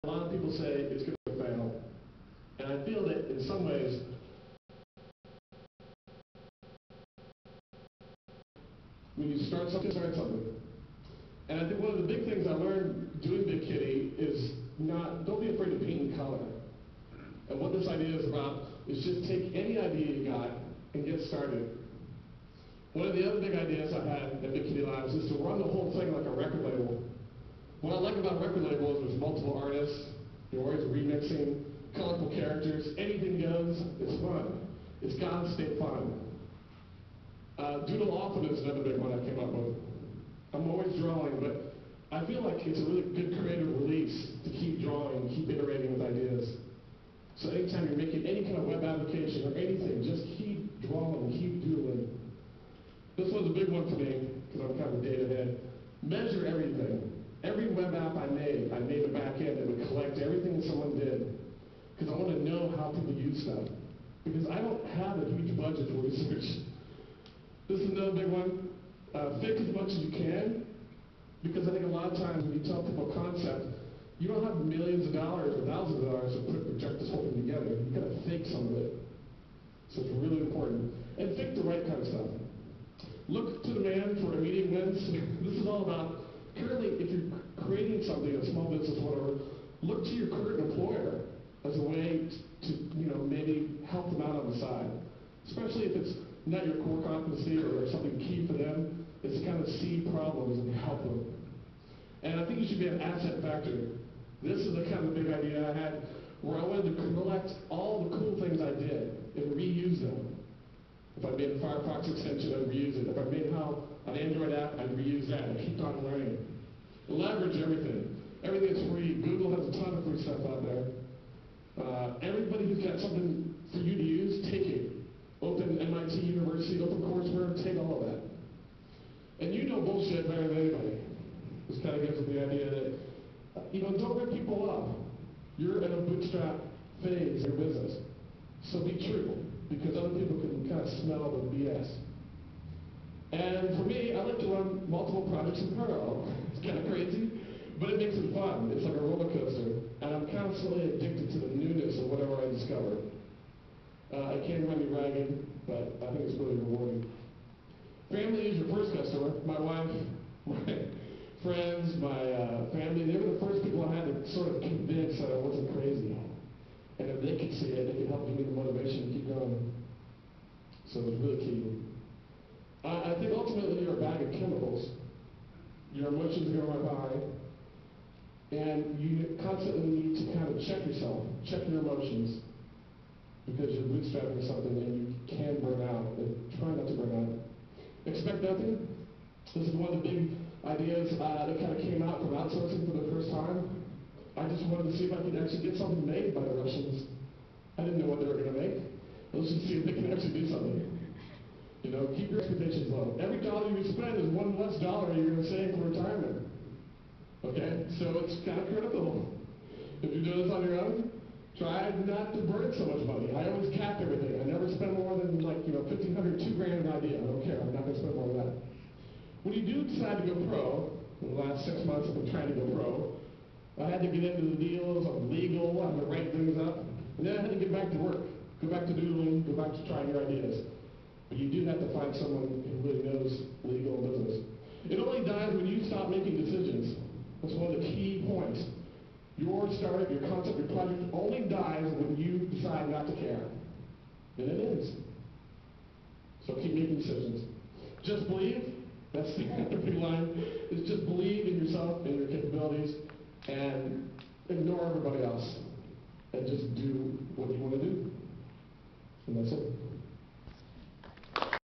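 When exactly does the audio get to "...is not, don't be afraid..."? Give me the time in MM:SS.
00:14.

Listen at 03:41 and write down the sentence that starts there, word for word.
In the last six months, I've been trying to go pro.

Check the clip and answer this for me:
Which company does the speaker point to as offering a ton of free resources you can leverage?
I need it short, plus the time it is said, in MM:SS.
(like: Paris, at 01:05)
Google, at 01:59.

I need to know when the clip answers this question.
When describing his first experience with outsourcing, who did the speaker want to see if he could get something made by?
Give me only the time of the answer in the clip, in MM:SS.
03:16.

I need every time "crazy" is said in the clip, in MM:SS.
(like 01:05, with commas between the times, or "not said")
02:26, 02:45.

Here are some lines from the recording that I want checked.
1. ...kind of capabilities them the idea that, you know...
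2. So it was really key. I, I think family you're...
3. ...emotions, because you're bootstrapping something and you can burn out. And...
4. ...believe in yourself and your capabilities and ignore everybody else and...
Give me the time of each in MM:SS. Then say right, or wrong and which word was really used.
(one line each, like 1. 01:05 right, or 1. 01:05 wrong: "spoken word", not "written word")
1. 02:11 wrong: "gives", not "capabilities"
2. 02:50 wrong: "ultimately", not "family"
3. 03:01 right
4. 04:11 right.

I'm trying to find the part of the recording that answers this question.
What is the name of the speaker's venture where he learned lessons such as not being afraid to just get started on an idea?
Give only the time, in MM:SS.
00:24.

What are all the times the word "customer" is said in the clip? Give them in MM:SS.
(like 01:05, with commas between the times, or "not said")
02:38.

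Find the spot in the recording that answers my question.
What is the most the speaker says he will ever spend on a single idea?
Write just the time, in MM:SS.
03:36.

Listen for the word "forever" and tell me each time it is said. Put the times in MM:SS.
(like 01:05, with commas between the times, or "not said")
not said.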